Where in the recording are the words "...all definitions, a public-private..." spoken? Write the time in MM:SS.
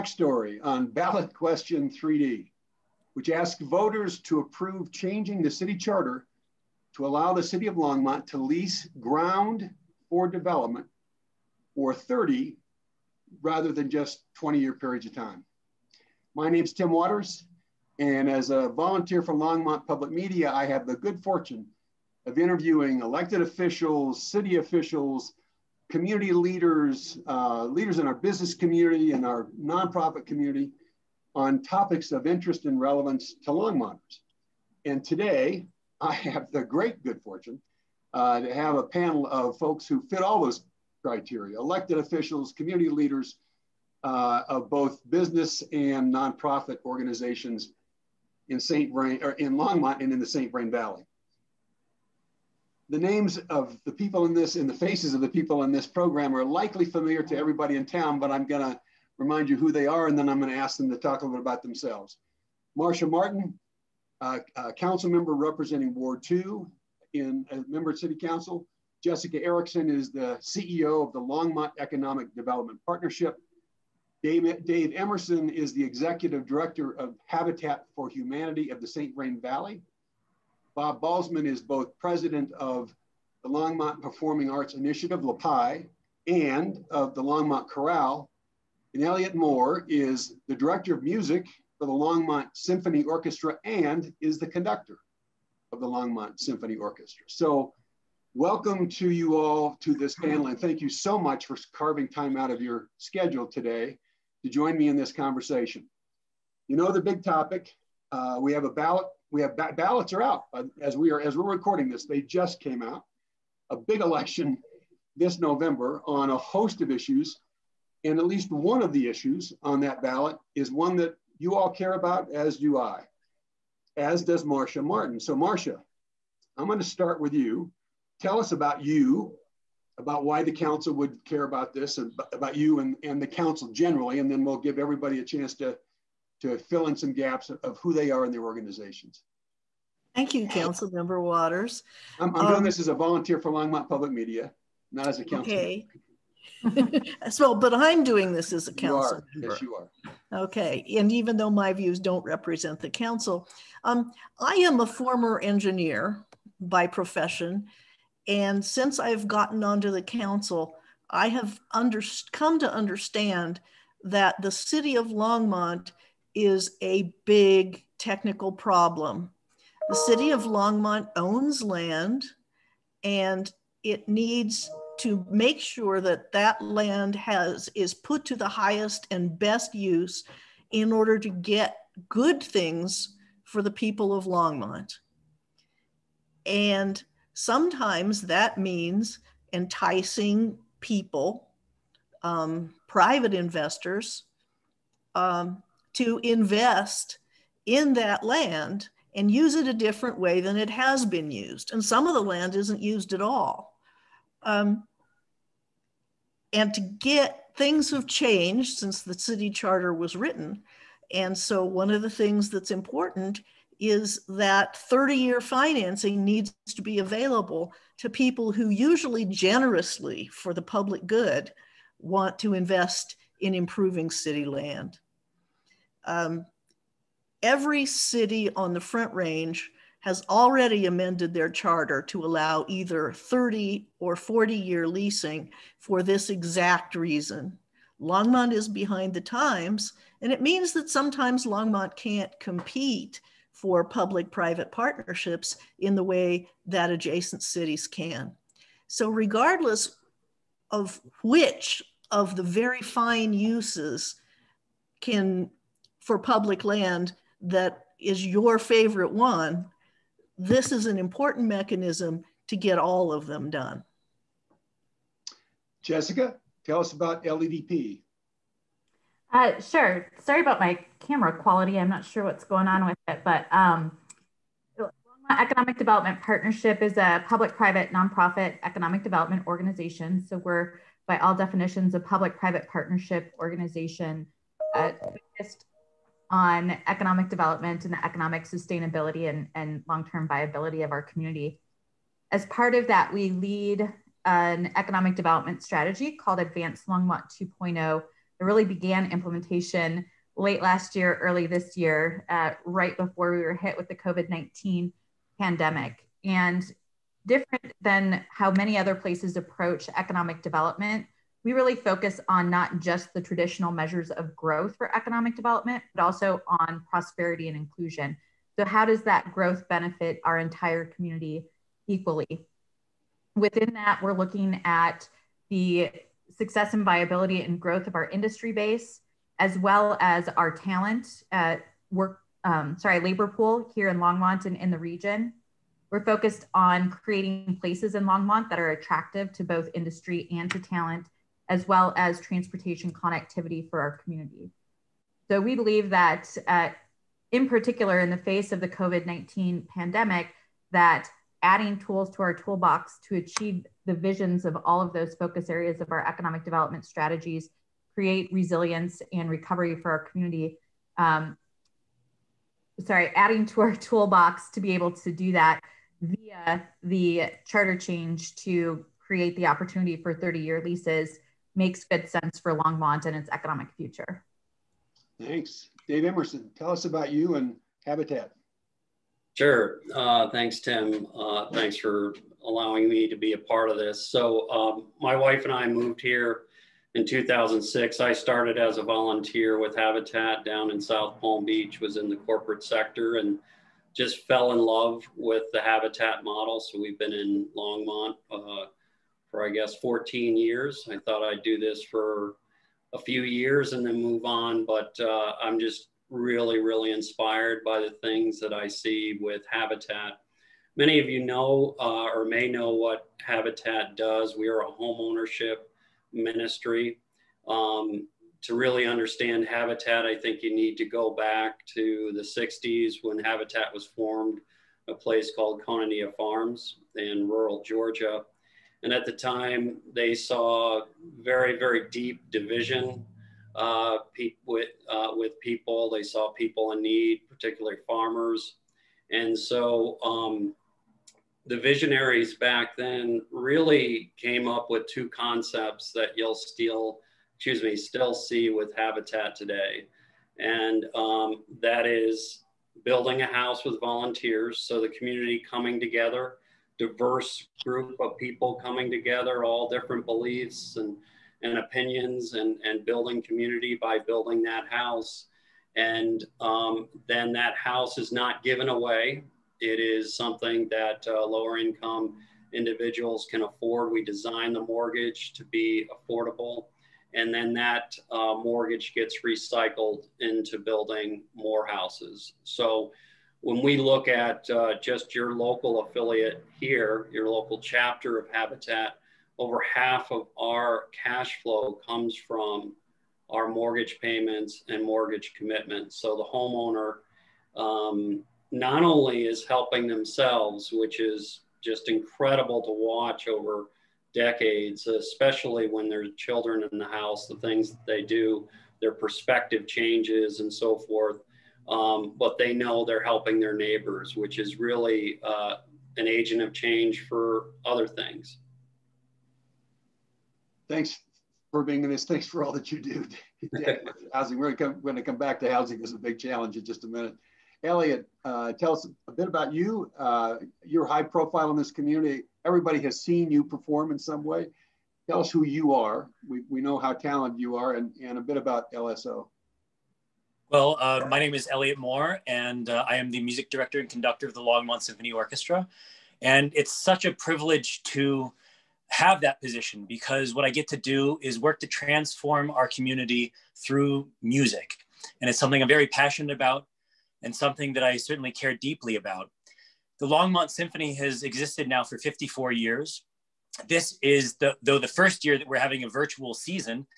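04:41.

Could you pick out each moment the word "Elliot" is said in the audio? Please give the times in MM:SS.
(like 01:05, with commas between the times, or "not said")
01:29, 08:47, 09:01.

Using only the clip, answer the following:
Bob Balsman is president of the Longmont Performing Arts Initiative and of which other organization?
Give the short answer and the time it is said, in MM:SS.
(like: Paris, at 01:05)
Longmont Chorale, at 01:27.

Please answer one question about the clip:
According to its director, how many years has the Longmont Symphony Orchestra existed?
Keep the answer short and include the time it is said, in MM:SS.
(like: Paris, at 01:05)
54, at 09:21.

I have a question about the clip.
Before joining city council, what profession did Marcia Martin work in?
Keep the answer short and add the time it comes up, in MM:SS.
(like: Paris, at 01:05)
Engineer, at 02:35.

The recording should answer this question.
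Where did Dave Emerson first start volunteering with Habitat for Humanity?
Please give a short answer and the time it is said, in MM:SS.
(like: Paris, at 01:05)
South Palm Beach, at 06:30.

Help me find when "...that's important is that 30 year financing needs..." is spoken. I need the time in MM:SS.
03:32.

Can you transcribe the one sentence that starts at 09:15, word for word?
And it's something I'm very passionate about and something that I certainly care deeply about.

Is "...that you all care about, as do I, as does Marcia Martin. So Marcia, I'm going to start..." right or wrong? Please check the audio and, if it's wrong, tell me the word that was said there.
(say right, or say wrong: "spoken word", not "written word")
right.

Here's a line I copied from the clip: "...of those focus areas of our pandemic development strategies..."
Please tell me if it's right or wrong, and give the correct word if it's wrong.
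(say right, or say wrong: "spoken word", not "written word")
wrong: "economic", not "pandemic".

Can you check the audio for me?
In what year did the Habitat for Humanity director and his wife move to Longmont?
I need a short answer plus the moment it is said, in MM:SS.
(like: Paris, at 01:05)
2006, at 06:27.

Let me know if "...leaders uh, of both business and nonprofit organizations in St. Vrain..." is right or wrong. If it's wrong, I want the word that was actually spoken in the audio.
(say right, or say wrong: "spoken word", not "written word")
right.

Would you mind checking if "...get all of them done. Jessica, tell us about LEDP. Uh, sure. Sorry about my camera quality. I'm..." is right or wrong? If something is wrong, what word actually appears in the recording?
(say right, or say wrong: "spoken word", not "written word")
right.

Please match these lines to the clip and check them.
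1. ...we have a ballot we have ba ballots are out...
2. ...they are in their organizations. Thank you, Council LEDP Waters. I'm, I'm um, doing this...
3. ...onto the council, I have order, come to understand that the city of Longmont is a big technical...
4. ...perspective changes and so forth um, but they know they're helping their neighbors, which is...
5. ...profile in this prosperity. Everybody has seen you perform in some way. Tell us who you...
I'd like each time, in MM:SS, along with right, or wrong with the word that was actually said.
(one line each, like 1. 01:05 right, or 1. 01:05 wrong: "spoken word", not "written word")
1. 01:48 right
2. 02:17 wrong: "Member", not "LEDP"
3. 02:39 wrong: "under", not "order"
4. 08:28 right
5. 08:51 wrong: "community", not "prosperity".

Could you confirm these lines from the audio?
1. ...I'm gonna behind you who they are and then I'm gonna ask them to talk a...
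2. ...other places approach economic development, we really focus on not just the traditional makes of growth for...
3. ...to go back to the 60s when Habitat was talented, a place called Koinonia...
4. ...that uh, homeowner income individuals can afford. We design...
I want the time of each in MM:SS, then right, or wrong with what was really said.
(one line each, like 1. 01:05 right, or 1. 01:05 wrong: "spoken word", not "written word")
1. 00:58 wrong: "remind", not "behind"
2. 05:08 wrong: "measures", not "makes"
3. 07:00 wrong: "formed", not "talented"
4. 07:50 wrong: "lower", not "homeowner".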